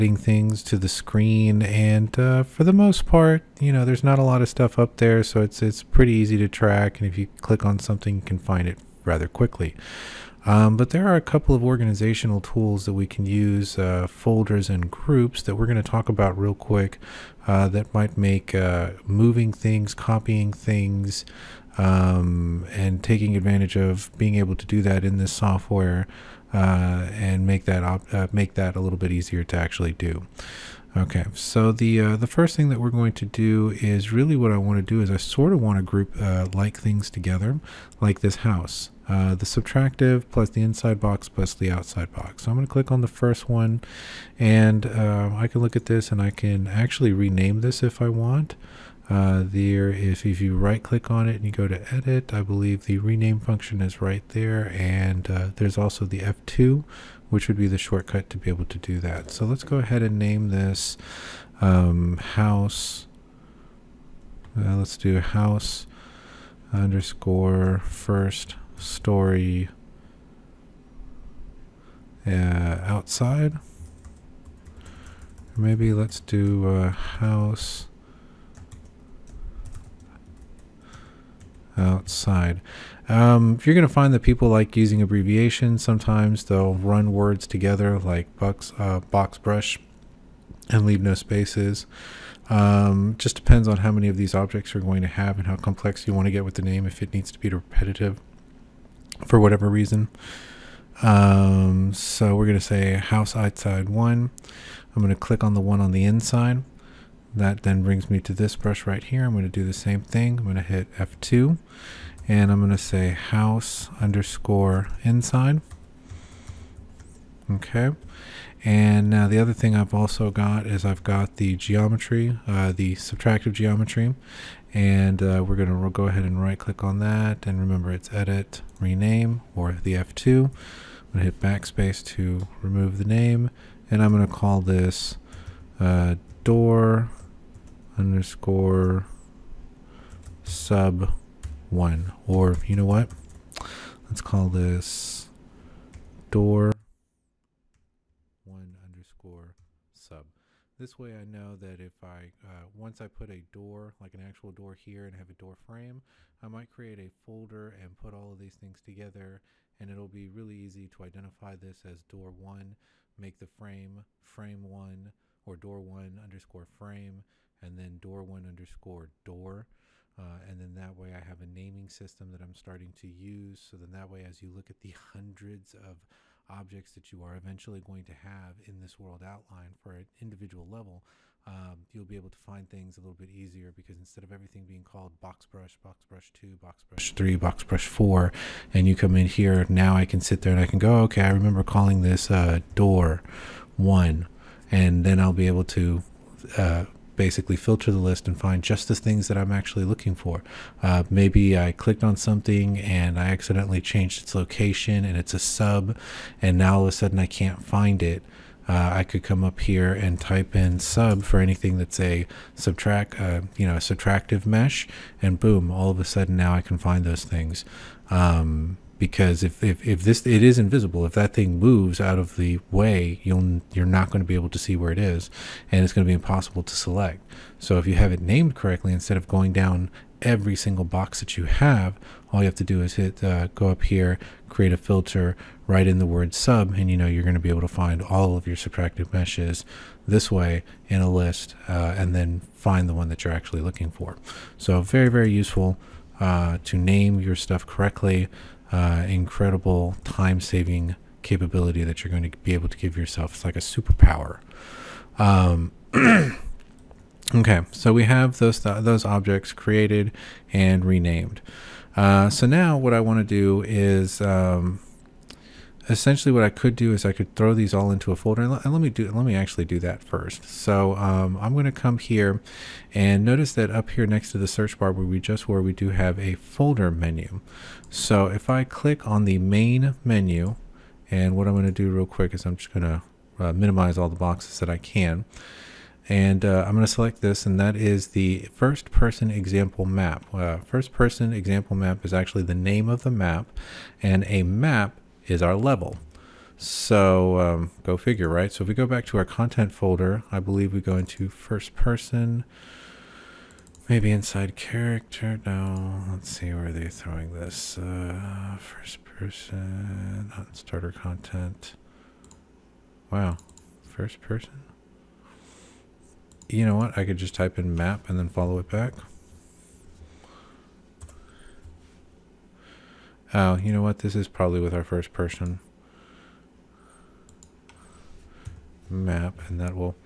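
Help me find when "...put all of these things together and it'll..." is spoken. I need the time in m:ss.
2:37.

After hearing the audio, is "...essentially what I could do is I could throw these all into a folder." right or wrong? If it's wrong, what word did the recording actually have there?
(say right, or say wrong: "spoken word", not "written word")
right.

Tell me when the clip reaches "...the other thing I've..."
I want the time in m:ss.
1:59.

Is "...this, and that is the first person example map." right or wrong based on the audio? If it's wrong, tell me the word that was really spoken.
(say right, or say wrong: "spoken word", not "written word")
right.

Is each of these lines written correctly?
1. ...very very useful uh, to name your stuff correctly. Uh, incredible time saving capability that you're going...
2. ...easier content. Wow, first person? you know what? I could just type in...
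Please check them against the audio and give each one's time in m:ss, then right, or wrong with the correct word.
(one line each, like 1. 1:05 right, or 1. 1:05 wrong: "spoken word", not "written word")
1. 4:04 right
2. 5:10 wrong: "starter", not "easier".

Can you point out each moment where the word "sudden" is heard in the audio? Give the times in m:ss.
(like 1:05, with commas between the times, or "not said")
3:26, 3:36.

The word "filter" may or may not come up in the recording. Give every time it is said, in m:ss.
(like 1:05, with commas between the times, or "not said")
3:17, 3:54.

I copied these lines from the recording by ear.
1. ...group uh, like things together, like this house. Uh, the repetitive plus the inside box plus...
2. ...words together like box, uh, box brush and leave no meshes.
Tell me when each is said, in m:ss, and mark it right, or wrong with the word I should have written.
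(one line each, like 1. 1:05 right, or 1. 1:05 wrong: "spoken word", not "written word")
1. 0:35 wrong: "subtractive", not "repetitive"
2. 1:27 wrong: "spaces", not "meshes".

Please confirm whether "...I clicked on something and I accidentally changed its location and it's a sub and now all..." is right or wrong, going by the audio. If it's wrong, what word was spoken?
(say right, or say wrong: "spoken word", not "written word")
right.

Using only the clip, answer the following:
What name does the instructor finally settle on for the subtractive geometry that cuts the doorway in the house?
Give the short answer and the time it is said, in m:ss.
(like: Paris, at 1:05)
door1_sub, at 2:26.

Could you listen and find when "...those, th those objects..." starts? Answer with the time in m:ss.
4:18.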